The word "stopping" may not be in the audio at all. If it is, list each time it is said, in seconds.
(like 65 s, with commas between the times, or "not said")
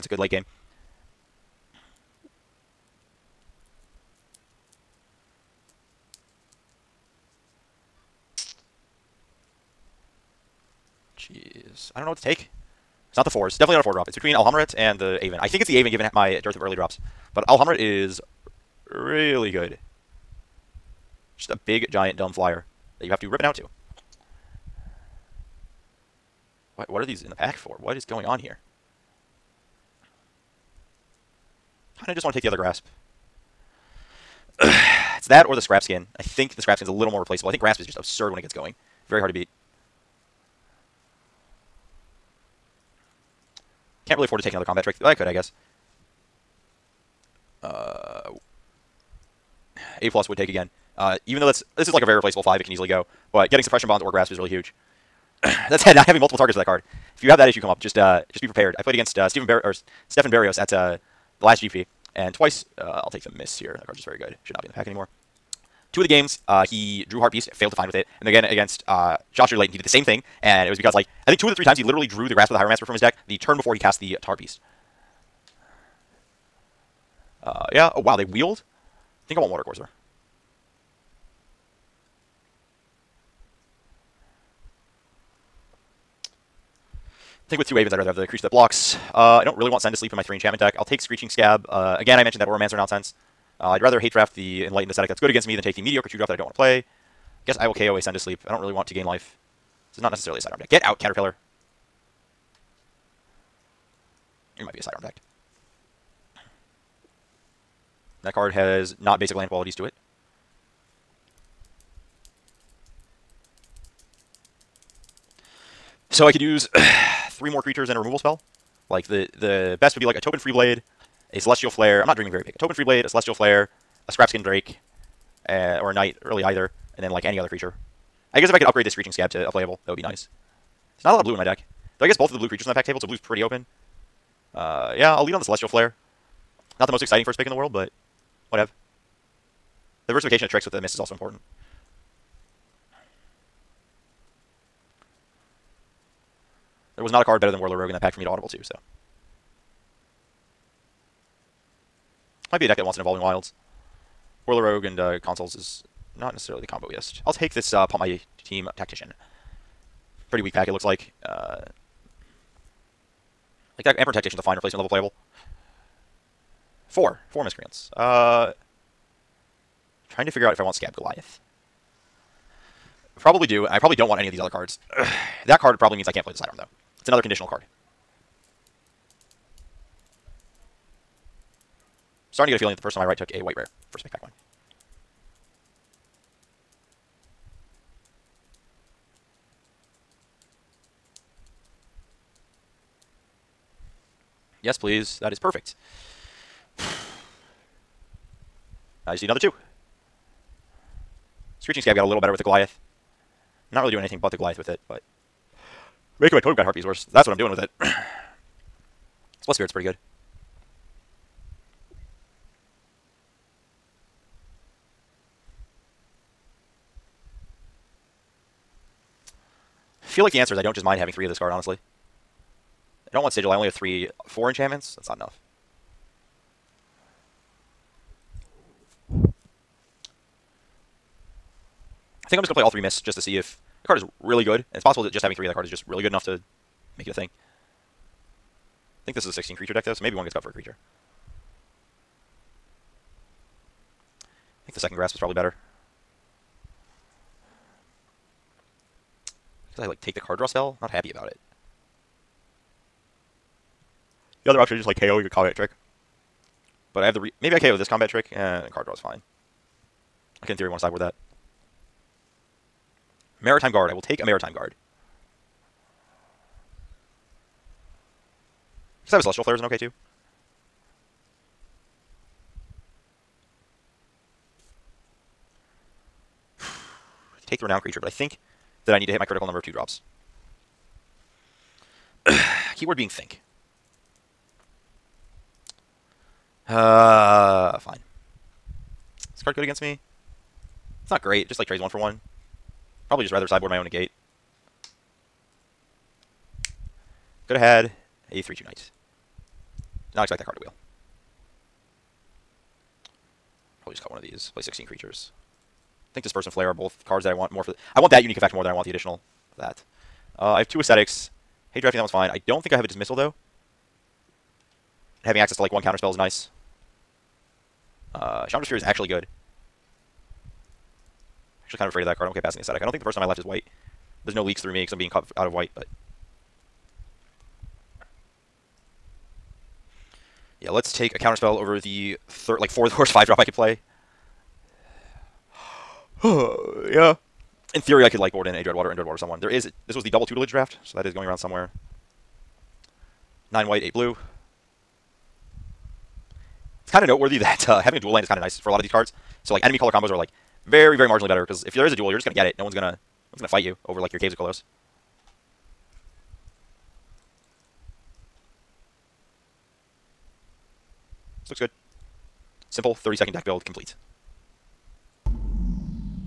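not said.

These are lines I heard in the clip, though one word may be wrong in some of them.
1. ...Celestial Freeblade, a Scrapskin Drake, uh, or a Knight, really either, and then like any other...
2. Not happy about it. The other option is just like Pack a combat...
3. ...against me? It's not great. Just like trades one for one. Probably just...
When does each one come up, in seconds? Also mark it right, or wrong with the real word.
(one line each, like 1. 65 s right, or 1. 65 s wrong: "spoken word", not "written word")
1. 123 s wrong: "Flare", not "Freeblade"
2. 250 s wrong: "KOing", not "Pack"
3. 289 s right.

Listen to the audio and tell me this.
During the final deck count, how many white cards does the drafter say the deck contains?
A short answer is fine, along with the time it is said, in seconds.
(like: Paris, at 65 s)
9, at 343 s.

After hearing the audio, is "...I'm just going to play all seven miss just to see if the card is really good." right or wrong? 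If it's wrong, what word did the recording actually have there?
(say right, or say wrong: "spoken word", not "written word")
wrong: "three", not "seven".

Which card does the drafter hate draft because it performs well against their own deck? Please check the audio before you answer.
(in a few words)
Enlightened Ascetic.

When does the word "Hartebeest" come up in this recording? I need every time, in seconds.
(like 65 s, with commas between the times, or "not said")
67 s, 74 s.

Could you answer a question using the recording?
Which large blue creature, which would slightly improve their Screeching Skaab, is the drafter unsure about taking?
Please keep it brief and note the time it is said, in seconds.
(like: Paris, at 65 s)
Skaab Goliath, at 170 s.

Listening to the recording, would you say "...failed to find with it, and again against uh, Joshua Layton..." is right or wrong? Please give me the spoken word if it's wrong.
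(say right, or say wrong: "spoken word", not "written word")
right.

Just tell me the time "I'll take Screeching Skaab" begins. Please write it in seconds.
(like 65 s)
90 s.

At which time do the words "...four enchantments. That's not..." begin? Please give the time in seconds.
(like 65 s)
224 s.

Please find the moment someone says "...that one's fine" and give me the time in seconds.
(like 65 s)
311 s.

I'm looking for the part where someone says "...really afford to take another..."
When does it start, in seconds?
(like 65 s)
44 s.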